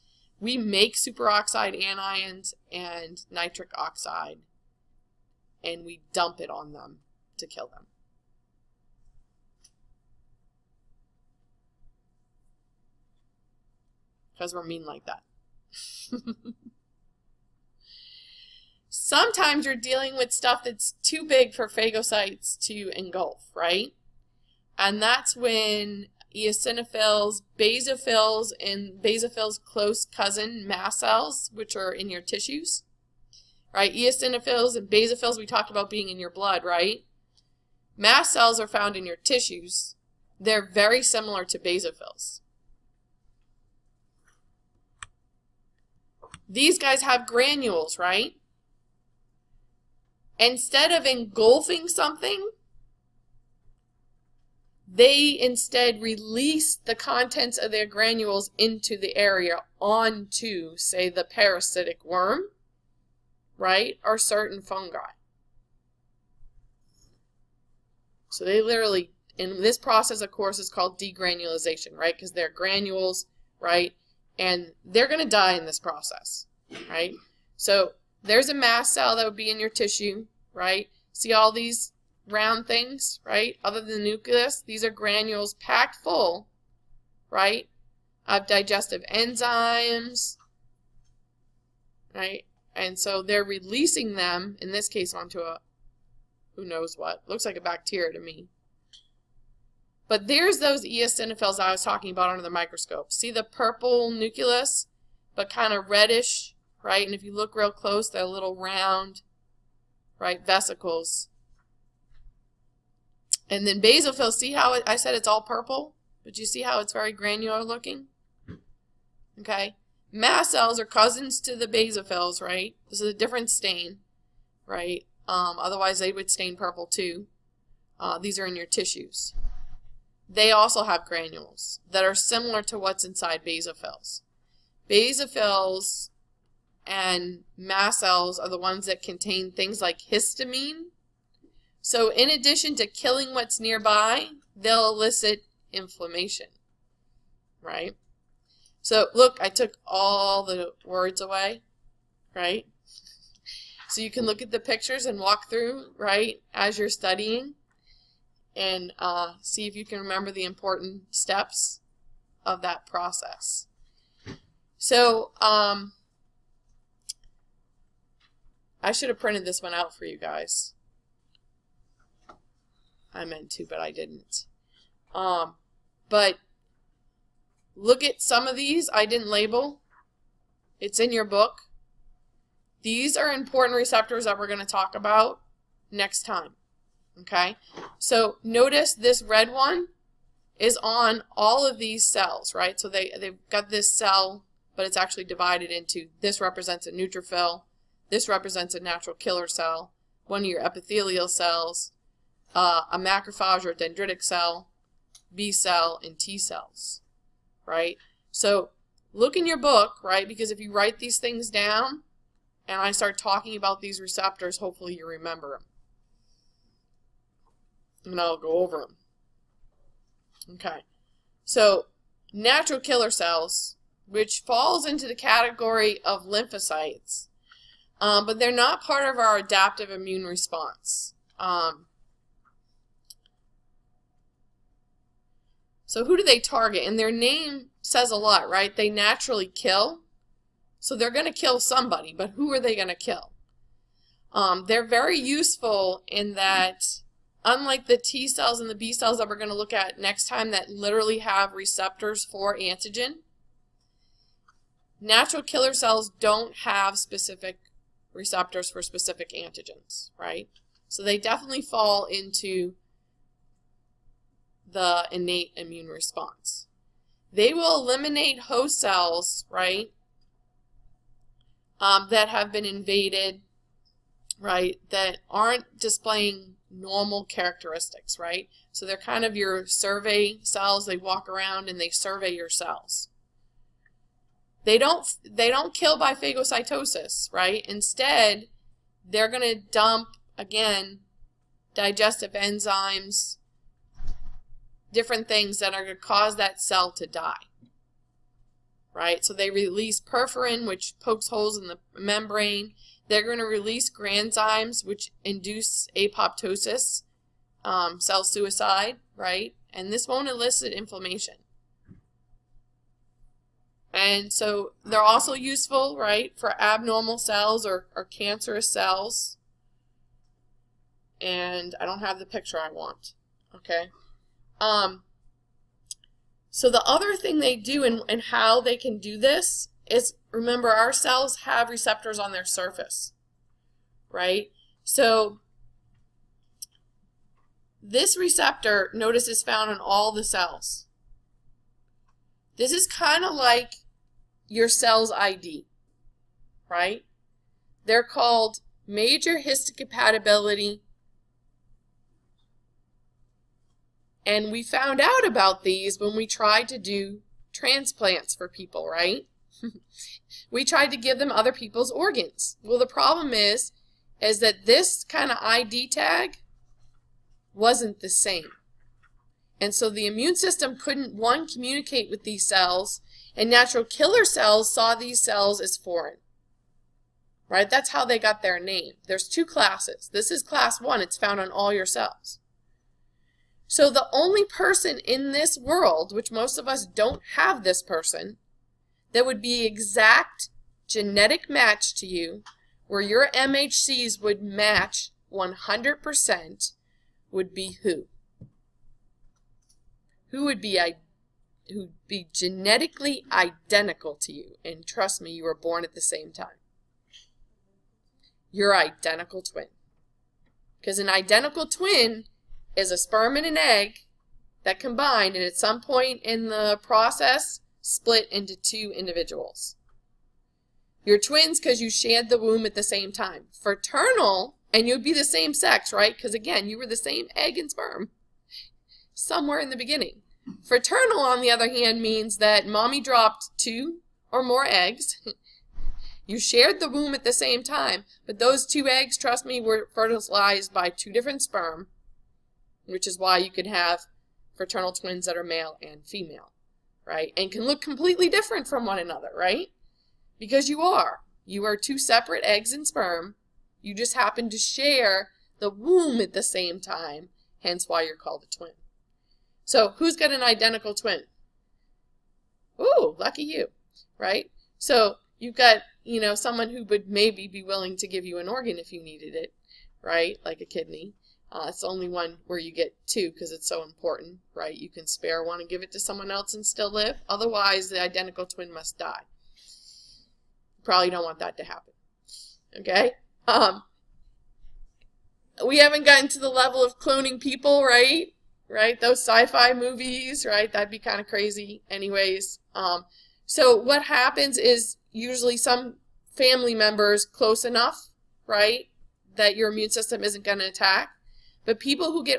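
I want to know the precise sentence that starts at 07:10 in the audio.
Fraternal, on the other hand, means that mommy dropped two or more eggs.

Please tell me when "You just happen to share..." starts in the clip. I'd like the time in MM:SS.
07:33.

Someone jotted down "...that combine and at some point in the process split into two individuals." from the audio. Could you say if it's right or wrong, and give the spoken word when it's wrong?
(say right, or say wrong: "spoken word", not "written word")
right.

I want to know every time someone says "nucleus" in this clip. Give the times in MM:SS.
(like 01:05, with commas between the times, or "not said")
01:24, 01:44.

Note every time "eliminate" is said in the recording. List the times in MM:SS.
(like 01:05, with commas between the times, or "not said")
04:27.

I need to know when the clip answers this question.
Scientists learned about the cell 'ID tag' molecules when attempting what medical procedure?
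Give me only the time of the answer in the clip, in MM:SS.
05:57.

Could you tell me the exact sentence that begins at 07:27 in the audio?
And can look completely different from one another, right?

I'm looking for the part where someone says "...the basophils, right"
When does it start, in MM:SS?
02:01.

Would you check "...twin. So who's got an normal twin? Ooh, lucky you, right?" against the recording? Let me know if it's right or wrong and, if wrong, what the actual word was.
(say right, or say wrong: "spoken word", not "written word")
wrong: "identical", not "normal".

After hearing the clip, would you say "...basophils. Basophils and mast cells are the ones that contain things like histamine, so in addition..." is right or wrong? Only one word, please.
right.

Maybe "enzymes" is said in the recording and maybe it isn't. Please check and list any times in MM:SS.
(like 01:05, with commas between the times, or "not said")
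01:29, 04:52.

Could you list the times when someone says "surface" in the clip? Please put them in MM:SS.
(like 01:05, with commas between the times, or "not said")
05:32.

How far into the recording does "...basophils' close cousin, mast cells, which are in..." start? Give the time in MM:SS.
00:29.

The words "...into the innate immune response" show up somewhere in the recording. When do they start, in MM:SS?
04:22.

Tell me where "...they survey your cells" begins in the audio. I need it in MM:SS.
04:41.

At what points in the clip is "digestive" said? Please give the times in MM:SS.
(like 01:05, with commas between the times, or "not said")
01:28, 04:51.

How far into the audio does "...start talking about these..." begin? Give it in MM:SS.
03:32.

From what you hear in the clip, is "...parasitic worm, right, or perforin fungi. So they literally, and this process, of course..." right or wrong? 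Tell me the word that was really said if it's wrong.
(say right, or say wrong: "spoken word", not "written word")
wrong: "certain", not "perforin".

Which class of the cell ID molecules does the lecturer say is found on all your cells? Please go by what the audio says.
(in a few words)
Class one.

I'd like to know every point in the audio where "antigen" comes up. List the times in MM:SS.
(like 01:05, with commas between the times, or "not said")
04:12, 04:19.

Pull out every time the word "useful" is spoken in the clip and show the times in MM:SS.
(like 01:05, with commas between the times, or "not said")
04:05, 05:15.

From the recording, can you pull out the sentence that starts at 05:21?
And I don't have the picture I want, okay?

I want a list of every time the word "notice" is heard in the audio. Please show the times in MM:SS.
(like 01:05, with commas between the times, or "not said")
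03:08, 05:38.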